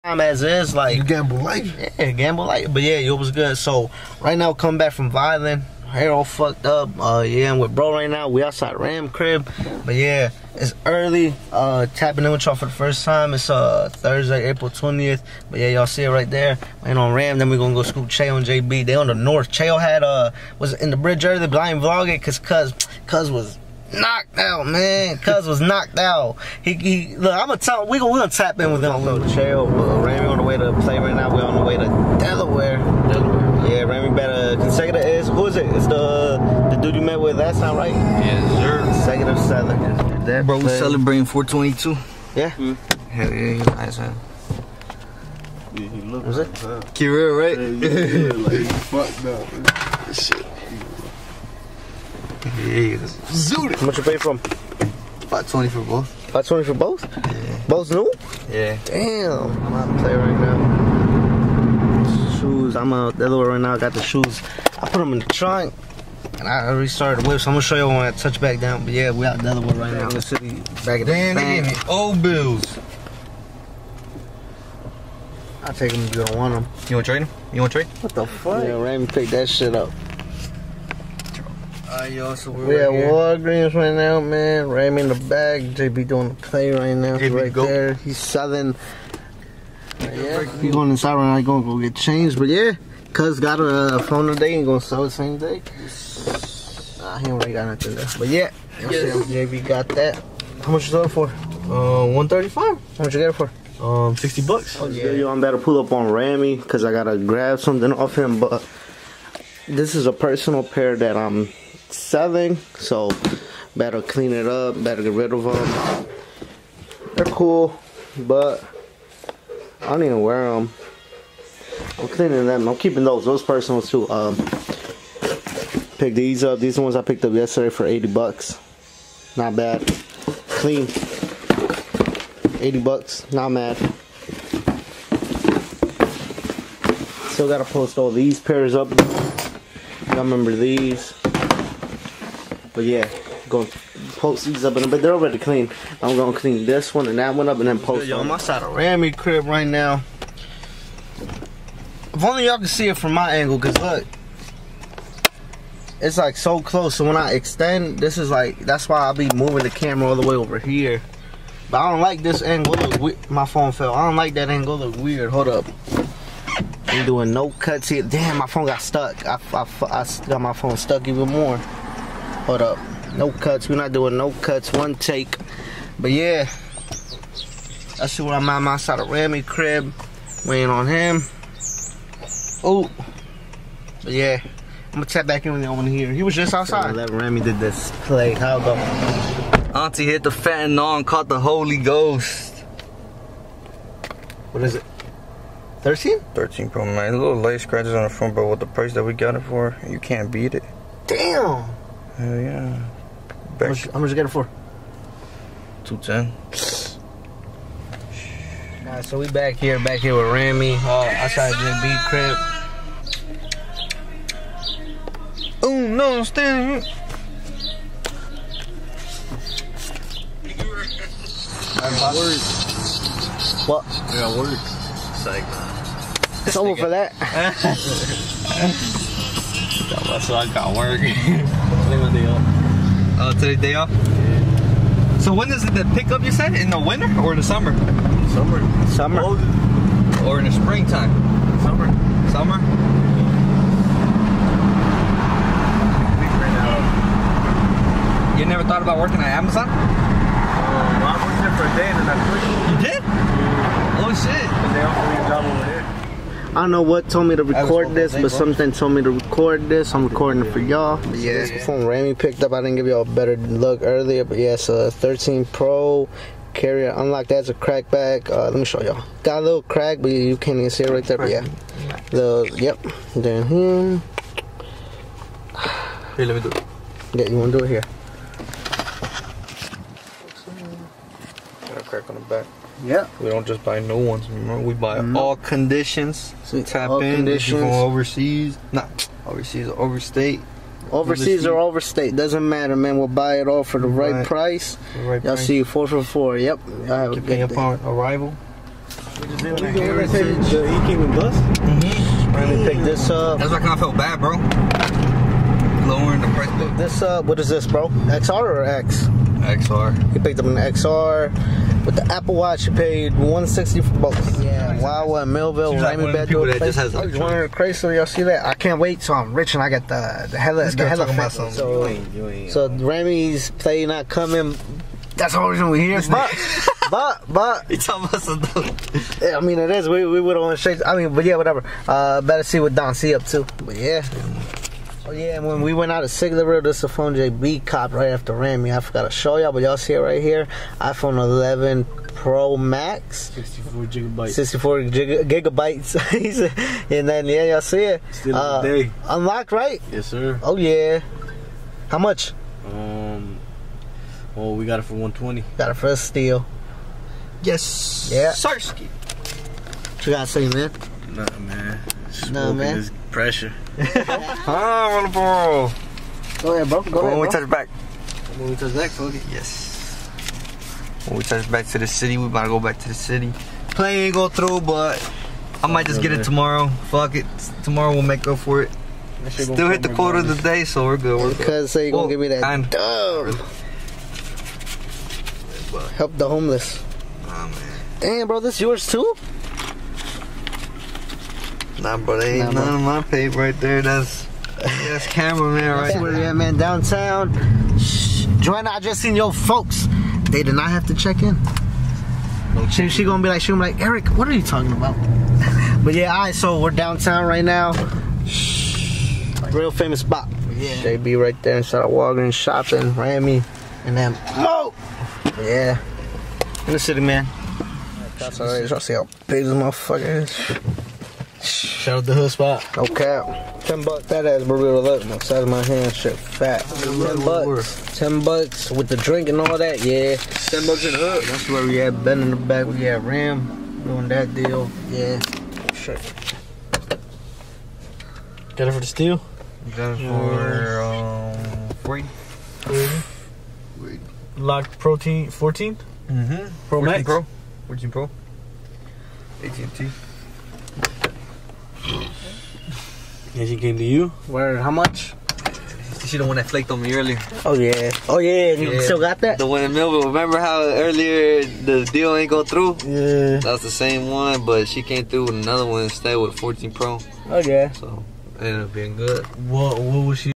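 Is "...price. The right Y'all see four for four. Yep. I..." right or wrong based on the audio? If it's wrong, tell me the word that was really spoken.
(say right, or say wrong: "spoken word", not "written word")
right.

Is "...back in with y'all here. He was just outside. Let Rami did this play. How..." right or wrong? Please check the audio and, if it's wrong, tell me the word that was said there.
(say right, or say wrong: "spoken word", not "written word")
right.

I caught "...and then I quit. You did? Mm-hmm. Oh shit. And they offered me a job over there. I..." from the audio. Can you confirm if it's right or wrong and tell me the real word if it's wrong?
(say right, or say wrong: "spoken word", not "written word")
right.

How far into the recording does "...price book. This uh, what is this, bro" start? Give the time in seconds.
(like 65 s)
306 s.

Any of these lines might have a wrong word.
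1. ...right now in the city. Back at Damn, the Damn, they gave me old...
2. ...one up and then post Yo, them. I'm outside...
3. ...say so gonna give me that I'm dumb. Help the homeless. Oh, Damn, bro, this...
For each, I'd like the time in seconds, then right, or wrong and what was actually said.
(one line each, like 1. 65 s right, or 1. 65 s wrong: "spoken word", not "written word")
1. 69 s right
2. 147 s right
3. 381 s right.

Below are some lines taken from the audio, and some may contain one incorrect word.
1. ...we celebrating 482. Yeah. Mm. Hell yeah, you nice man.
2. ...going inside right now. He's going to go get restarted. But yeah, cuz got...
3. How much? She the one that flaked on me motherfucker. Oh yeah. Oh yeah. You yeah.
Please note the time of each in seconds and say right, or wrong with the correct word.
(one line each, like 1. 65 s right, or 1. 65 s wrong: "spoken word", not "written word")
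1. 40 s wrong: "422", not "482"
2. 90 s wrong: "changed", not "restarted"
3. 454 s wrong: "earlier", not "motherfucker".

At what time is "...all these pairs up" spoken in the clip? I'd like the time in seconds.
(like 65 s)
137 s.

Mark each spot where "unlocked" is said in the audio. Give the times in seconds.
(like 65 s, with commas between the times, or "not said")
266 s, 349 s.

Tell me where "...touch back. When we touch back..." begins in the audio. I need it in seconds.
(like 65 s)
367 s.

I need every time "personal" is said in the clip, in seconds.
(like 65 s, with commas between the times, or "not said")
110 s, 123 s.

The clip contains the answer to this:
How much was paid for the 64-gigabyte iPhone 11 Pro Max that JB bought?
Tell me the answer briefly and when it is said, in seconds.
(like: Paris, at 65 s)
$120, at 354 s.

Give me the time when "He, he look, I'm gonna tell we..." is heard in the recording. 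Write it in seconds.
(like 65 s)
26 s.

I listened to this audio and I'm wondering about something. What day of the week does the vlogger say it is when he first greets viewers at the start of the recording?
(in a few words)
Thursday.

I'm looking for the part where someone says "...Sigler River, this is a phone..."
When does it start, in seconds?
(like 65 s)
336 s.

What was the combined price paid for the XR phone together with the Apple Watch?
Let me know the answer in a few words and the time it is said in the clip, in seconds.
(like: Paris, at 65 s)
$160, at 313 s.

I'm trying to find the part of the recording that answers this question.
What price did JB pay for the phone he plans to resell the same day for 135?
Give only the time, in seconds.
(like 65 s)
104 s.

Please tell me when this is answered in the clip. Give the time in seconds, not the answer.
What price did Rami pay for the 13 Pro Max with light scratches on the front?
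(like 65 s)
205 s.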